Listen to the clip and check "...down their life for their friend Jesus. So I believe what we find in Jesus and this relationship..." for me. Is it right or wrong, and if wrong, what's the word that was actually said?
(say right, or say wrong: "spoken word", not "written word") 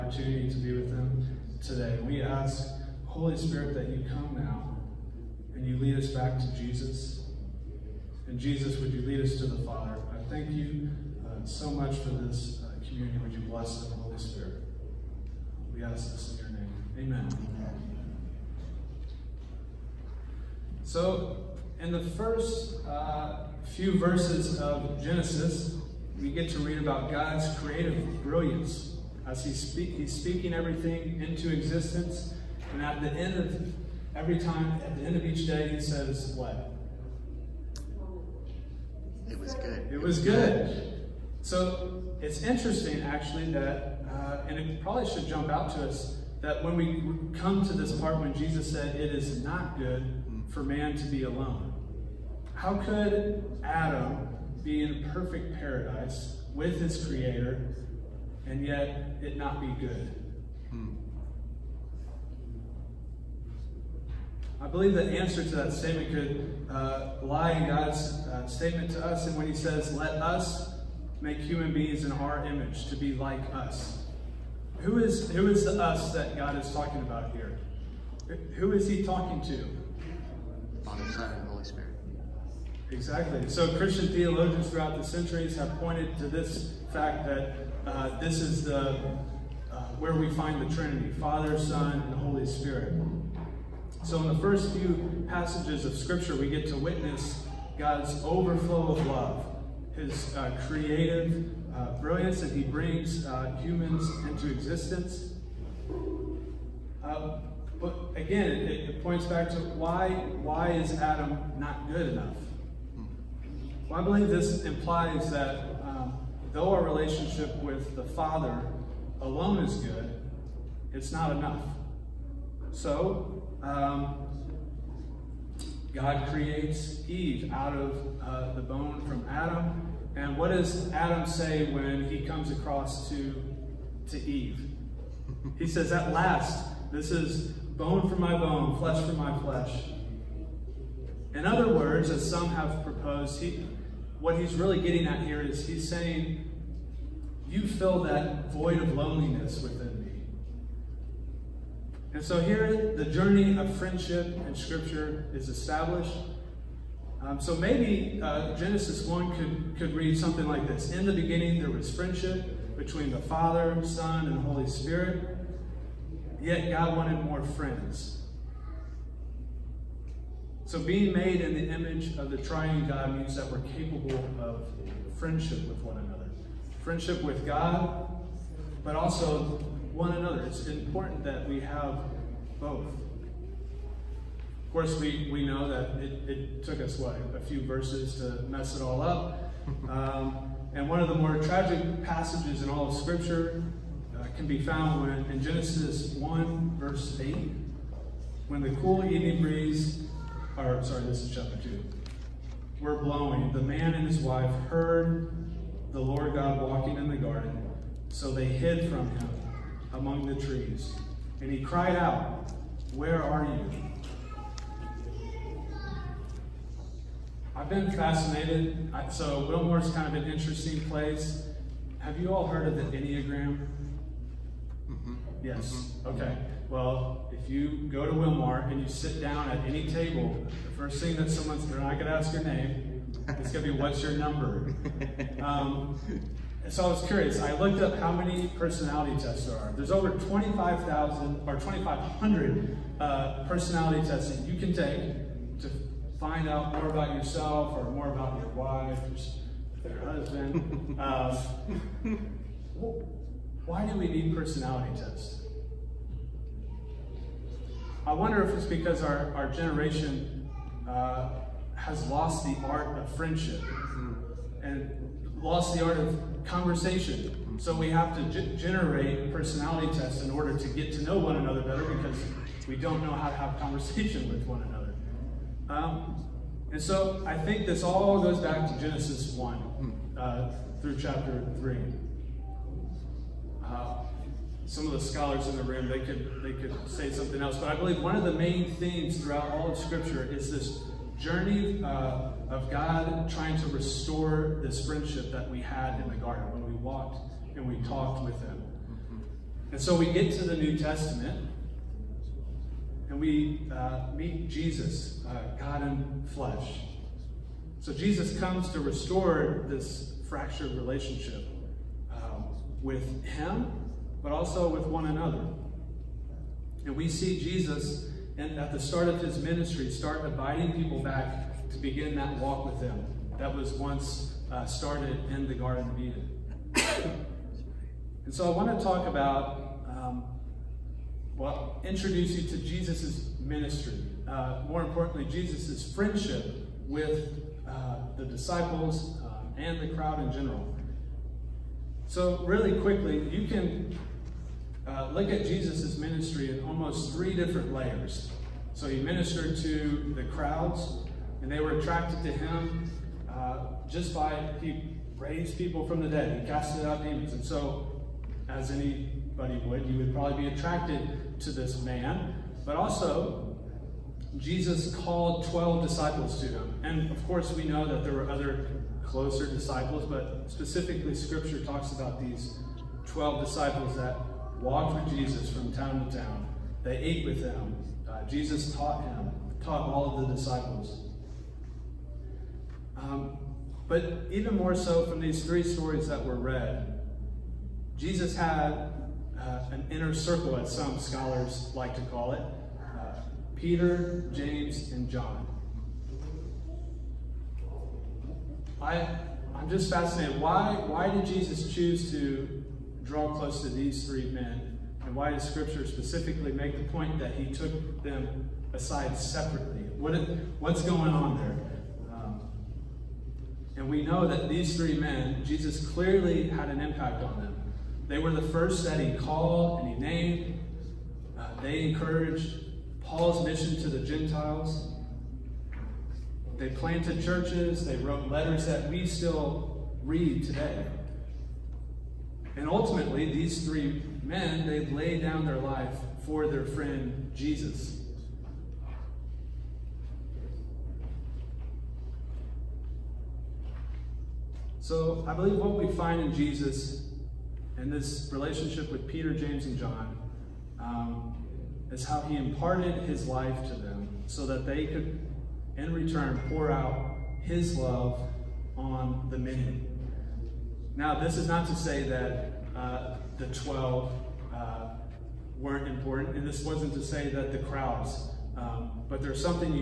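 right.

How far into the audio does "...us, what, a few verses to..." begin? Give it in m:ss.
3:06.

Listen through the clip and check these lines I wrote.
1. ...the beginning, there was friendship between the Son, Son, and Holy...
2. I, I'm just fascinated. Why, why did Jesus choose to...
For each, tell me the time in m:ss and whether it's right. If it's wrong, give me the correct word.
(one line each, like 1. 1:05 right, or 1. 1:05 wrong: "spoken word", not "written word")
1. 2:41 wrong: "Father", not "Son"
2. 6:38 right.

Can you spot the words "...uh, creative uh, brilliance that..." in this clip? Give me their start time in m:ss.
1:40.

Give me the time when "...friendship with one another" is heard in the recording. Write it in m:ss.
2:55.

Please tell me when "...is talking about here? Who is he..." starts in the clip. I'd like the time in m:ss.
1:16.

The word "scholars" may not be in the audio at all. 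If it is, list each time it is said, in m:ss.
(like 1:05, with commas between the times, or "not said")
4:45, 6:30.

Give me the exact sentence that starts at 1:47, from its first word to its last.
Uh, but again, it, it points back to why, why is Adam not good enough?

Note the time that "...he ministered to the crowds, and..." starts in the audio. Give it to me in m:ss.
5:48.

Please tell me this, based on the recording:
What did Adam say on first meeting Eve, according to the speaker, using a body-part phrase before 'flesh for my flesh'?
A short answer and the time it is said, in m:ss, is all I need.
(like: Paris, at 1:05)
bone for my bone, at 2:17.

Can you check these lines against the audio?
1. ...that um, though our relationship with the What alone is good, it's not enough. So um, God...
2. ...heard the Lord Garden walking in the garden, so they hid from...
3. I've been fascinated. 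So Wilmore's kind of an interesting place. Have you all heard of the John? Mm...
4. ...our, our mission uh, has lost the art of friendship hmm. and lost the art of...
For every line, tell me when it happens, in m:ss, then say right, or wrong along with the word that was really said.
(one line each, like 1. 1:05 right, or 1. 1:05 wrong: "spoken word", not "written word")
1. 1:55 wrong: "Father", not "What"
2. 3:24 wrong: "God", not "Garden"
3. 3:37 wrong: "Enneagram", not "John"
4. 4:19 wrong: "generation", not "mission".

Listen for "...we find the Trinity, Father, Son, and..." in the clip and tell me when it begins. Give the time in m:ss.
1:30.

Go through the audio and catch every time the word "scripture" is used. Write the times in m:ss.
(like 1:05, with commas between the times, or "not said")
1:35, 2:34, 3:12, 4:49, 6:11, 6:45.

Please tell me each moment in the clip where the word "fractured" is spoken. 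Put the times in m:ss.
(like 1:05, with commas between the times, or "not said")
5:10.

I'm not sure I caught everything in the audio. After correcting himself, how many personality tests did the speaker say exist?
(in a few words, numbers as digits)
2,500.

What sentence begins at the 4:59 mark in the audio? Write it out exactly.
And so we get to the New Testament and we uh, meet Jesus, uh, God in flesh.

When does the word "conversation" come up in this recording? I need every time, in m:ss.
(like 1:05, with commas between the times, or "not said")
4:26, 4:33.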